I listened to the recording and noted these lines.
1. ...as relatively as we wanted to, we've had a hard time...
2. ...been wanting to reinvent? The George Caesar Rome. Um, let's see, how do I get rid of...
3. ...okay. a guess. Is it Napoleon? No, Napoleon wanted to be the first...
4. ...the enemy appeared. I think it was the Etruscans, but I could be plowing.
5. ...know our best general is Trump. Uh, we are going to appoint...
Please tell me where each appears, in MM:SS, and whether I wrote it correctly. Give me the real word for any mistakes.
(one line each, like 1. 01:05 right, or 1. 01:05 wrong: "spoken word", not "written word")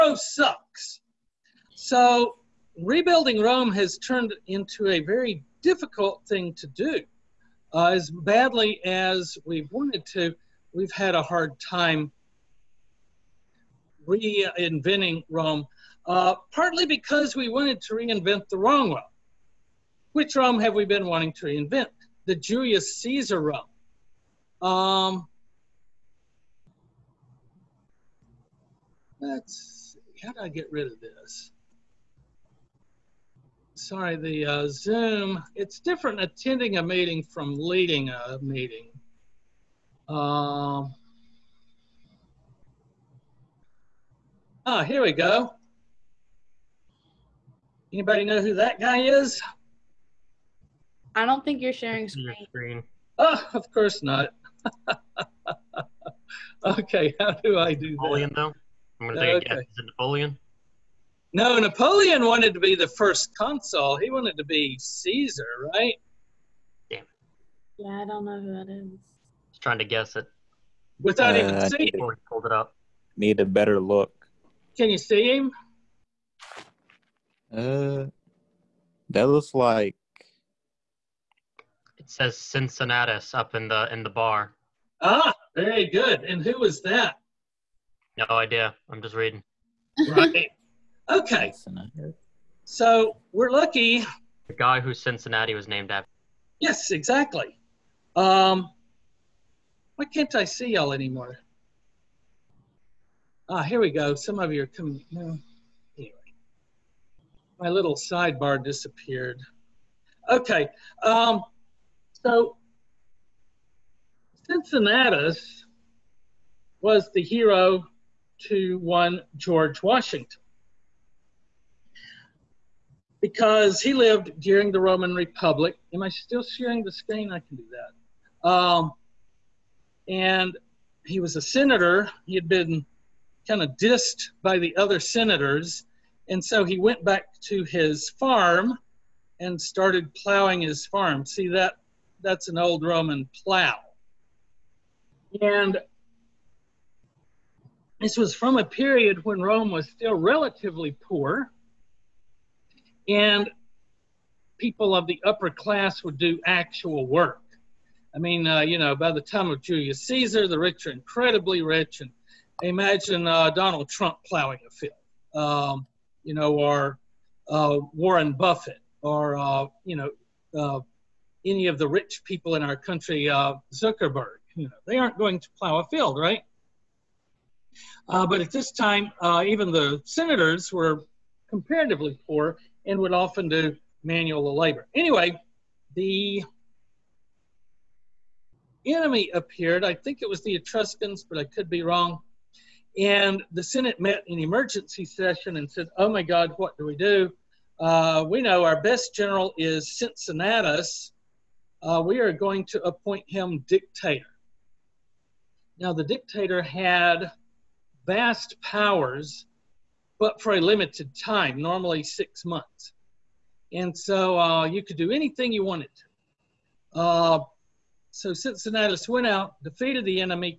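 1. 00:07 wrong: "badly", not "relatively"
2. 00:20 wrong: "Julius", not "George"
3. 00:59 right
4. 03:05 wrong: "wrong", not "plowing"
5. 03:18 wrong: "Cincinnatus", not "Trump".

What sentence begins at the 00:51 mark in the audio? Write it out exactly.
I don't think you're sharing screen.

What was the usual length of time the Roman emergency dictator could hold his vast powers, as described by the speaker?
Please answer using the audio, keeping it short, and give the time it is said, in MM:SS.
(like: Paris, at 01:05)
6 months, at 03:32.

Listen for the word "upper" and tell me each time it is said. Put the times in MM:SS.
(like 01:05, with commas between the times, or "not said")
02:35.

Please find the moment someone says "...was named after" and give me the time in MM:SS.
01:35.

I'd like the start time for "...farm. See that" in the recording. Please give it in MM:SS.
02:20.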